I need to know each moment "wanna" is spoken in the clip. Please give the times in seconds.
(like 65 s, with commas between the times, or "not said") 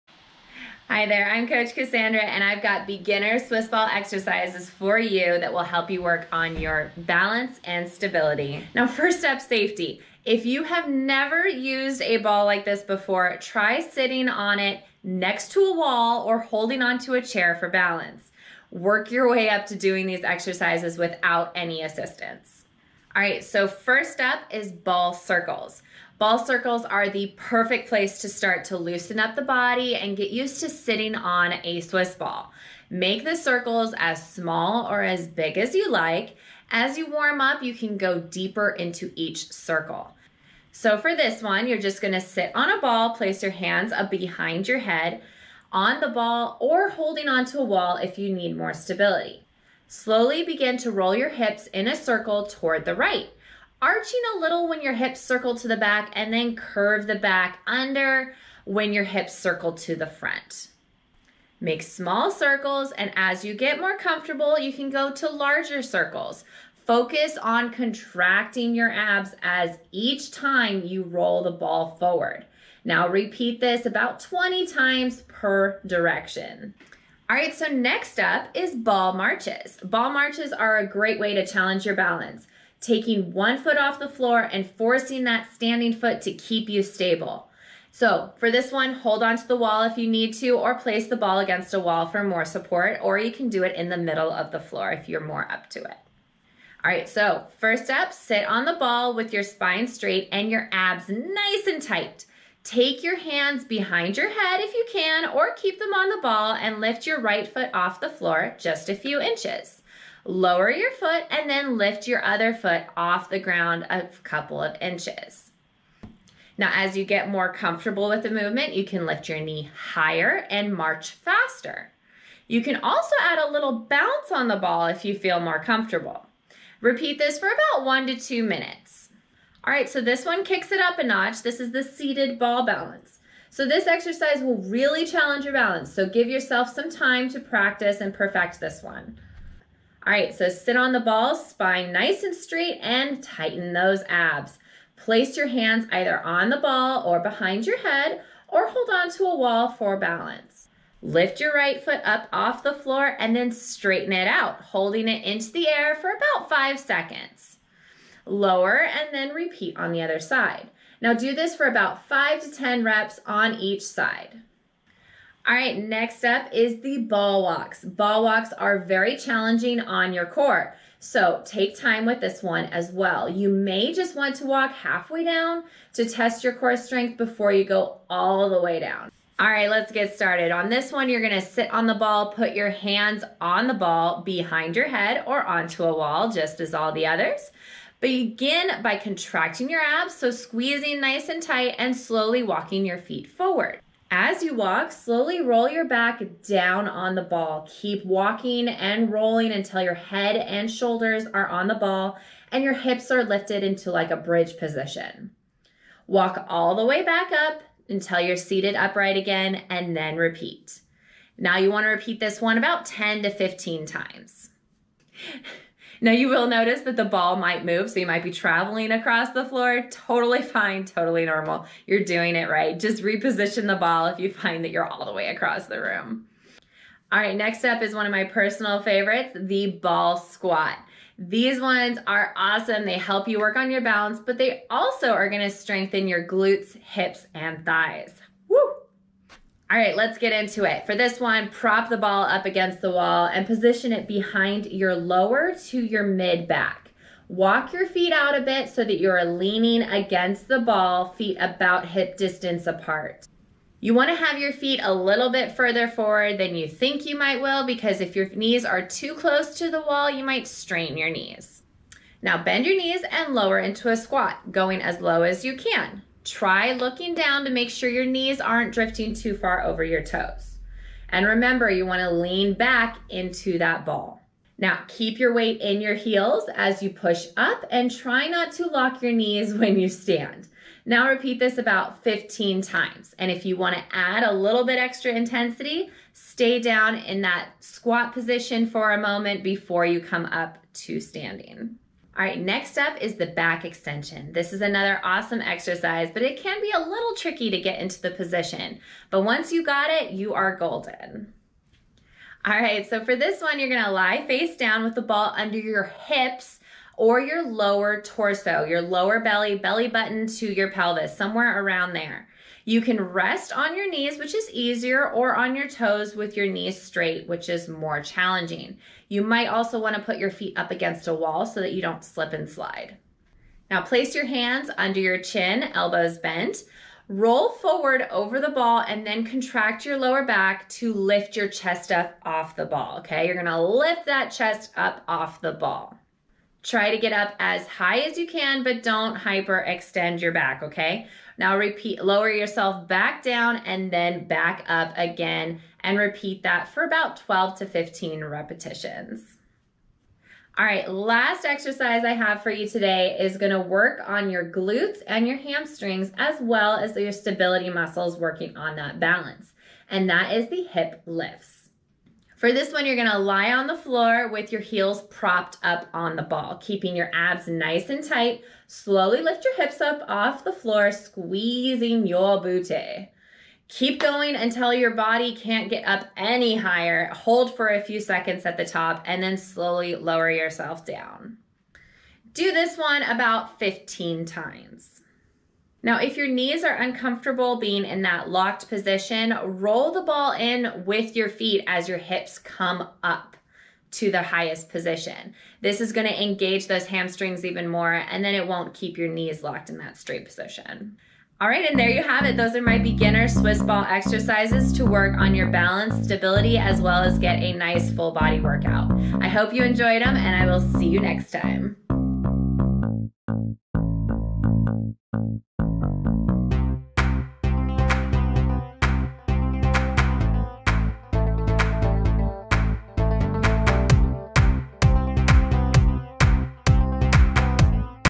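271 s, 283 s.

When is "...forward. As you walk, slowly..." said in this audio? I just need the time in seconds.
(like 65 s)
193 s.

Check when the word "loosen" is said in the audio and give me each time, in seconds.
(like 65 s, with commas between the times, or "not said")
28 s.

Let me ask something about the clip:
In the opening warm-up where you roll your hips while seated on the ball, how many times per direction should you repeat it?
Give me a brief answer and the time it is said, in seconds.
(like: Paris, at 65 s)
20, at 74 s.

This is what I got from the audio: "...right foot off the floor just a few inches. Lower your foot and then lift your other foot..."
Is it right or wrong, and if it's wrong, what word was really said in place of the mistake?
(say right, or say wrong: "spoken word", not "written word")
right.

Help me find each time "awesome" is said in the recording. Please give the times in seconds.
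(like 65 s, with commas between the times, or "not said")
232 s, 295 s.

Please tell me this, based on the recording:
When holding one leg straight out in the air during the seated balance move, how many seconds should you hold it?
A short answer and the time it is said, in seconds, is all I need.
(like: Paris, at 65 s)
5 seconds, at 156 s.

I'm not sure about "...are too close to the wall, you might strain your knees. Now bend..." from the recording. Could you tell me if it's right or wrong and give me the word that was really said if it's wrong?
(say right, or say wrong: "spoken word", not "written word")
right.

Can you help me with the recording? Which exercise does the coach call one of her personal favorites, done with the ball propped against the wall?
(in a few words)
ball squat.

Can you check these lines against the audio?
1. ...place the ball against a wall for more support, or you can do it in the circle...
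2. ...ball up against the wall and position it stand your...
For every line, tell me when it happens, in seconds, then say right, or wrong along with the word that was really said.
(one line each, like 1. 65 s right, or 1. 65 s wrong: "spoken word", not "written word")
1. 90 s wrong: "middle", not "circle"
2. 241 s wrong: "behind", not "stand".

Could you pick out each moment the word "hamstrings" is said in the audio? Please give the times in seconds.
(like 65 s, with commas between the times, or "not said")
355 s, 396 s.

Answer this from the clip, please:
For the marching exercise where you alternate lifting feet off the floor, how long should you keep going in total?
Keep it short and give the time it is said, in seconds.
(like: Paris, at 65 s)
1 to 2 minutes, at 127 s.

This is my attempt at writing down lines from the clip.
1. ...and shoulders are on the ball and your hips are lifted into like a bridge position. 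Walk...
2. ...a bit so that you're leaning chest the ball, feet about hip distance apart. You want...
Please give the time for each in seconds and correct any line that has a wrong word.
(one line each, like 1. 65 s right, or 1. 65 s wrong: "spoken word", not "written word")
1. 200 s right
2. 248 s wrong: "against", not "chest".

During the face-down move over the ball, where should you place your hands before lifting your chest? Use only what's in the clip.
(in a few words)
under your chin.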